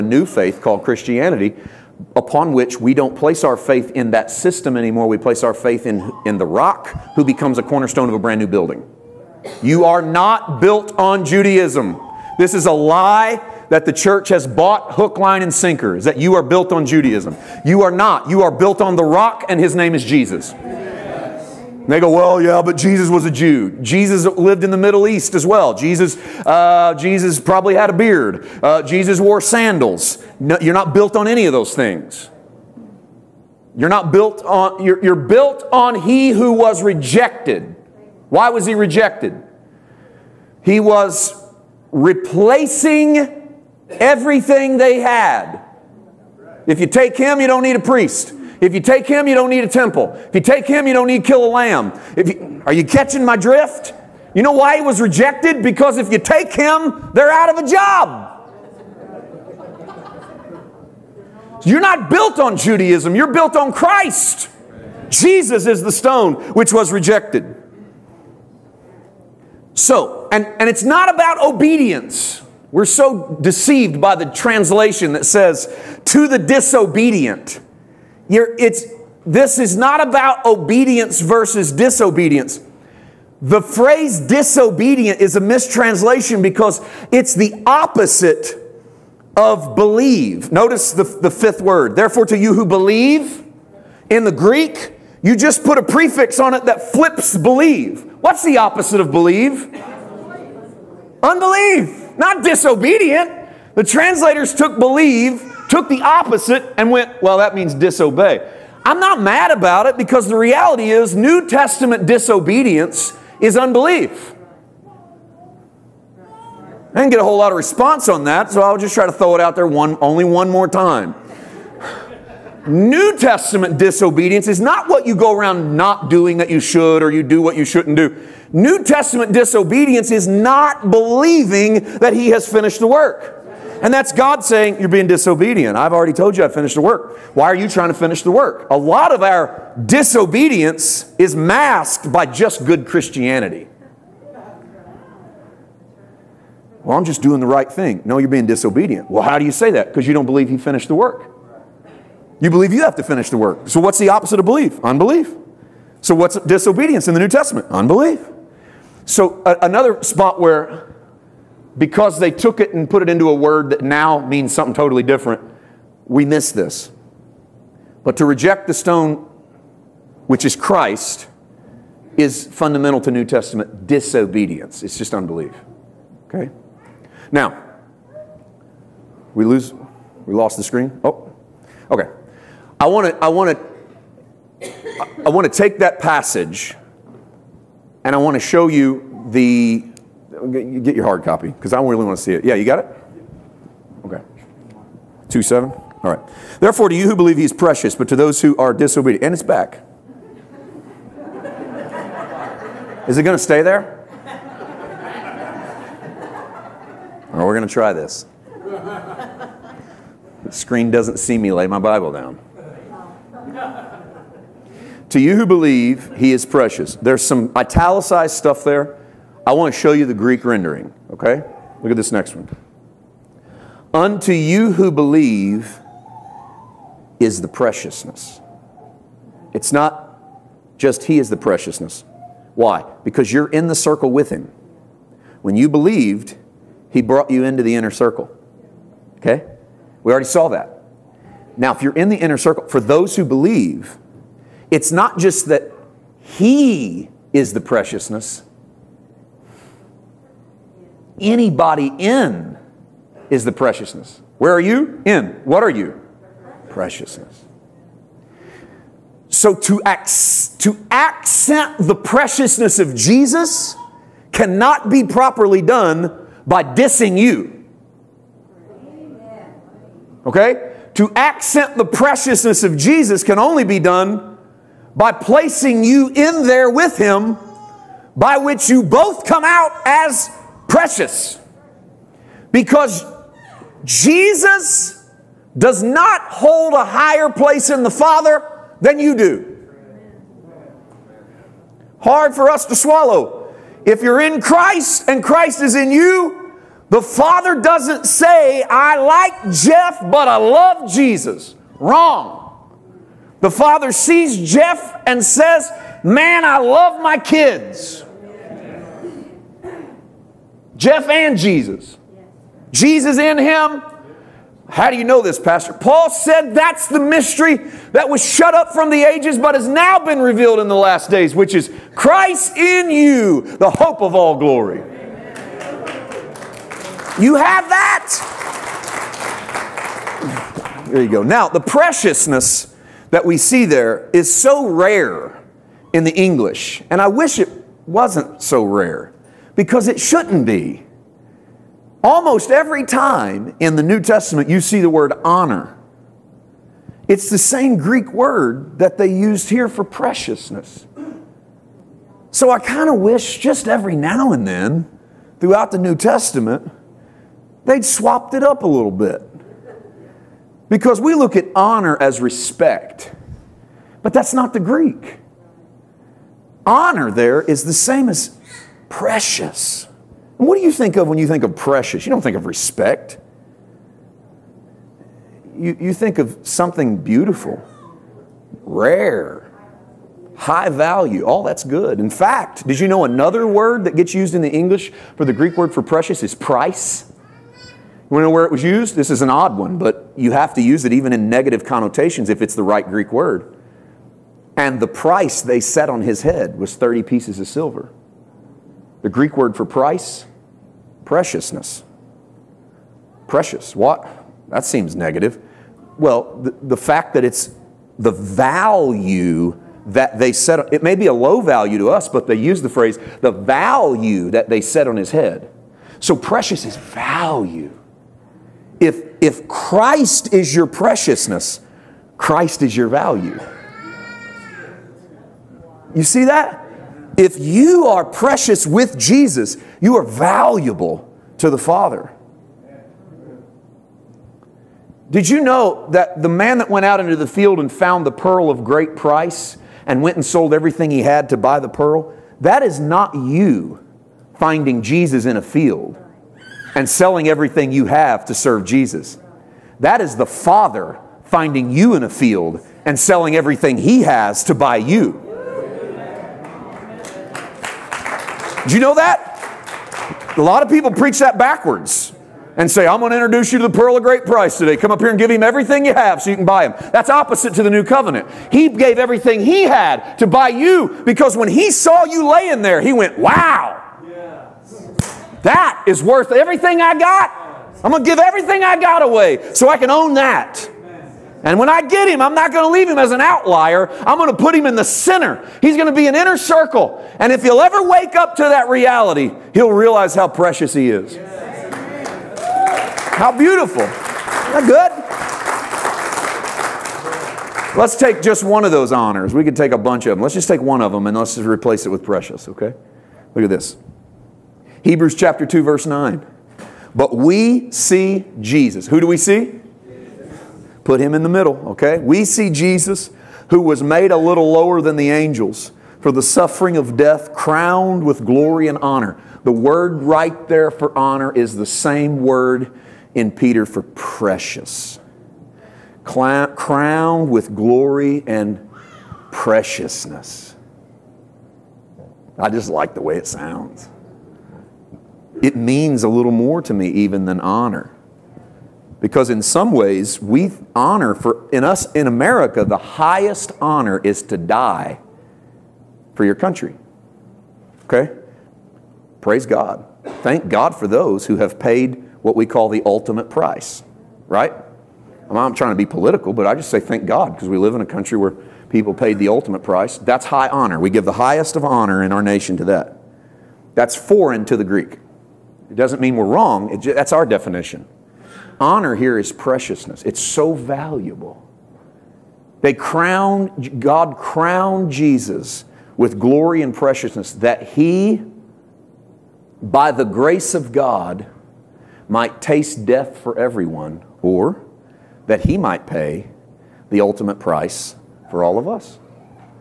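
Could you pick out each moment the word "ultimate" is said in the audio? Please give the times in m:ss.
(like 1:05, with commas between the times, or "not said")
9:12, 9:19, 9:46.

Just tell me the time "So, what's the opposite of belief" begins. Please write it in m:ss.
2:33.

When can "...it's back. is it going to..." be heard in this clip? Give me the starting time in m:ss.
3:19.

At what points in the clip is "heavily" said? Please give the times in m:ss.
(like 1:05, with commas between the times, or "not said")
not said.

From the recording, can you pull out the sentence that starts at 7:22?
That is not you finding Jesus in a field and selling everything you have to serve Jesus.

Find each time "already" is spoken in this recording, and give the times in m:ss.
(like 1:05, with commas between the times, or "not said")
2:15, 4:00.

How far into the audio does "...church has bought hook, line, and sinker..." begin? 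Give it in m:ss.
0:13.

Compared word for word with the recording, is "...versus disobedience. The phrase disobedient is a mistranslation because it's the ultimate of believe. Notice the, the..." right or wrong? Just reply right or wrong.
wrong.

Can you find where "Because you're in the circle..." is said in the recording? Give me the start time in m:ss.
3:53.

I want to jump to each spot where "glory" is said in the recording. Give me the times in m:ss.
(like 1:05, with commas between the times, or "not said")
5:24, 8:38, 8:47, 9:36.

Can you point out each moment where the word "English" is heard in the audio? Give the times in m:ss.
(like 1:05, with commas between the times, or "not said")
5:36, 6:24.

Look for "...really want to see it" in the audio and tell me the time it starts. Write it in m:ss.
3:11.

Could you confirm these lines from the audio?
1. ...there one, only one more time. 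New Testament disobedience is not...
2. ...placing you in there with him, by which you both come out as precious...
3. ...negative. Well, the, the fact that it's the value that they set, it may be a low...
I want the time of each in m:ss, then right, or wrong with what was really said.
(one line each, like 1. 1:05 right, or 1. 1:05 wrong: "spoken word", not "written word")
1. 1:59 right
2. 4:35 right
3. 6:44 right.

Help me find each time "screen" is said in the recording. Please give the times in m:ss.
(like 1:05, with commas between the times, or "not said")
3:00, 3:30.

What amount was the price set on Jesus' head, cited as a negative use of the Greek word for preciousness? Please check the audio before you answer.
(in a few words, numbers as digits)
30 pieces of silver.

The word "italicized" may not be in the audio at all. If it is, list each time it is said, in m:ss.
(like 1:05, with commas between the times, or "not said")
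3:37.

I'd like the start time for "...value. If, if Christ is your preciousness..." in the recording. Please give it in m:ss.
6:56.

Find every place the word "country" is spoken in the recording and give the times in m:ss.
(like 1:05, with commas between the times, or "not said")
9:06, 9:17.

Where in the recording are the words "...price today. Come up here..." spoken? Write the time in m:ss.
7:44.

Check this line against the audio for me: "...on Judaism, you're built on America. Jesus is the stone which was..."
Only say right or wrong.
wrong.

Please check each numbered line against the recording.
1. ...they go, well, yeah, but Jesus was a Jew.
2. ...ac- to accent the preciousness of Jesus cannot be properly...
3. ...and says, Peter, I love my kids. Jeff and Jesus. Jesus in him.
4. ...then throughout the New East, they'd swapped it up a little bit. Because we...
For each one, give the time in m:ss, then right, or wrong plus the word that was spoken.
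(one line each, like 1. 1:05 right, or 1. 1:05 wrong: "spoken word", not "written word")
1. 0:21 right
2. 4:19 right
3. 5:05 wrong: "Man", not "Peter"
4. 5:54 wrong: "Testament", not "East".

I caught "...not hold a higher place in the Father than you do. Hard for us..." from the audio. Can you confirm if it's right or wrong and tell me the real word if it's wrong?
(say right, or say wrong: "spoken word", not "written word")
right.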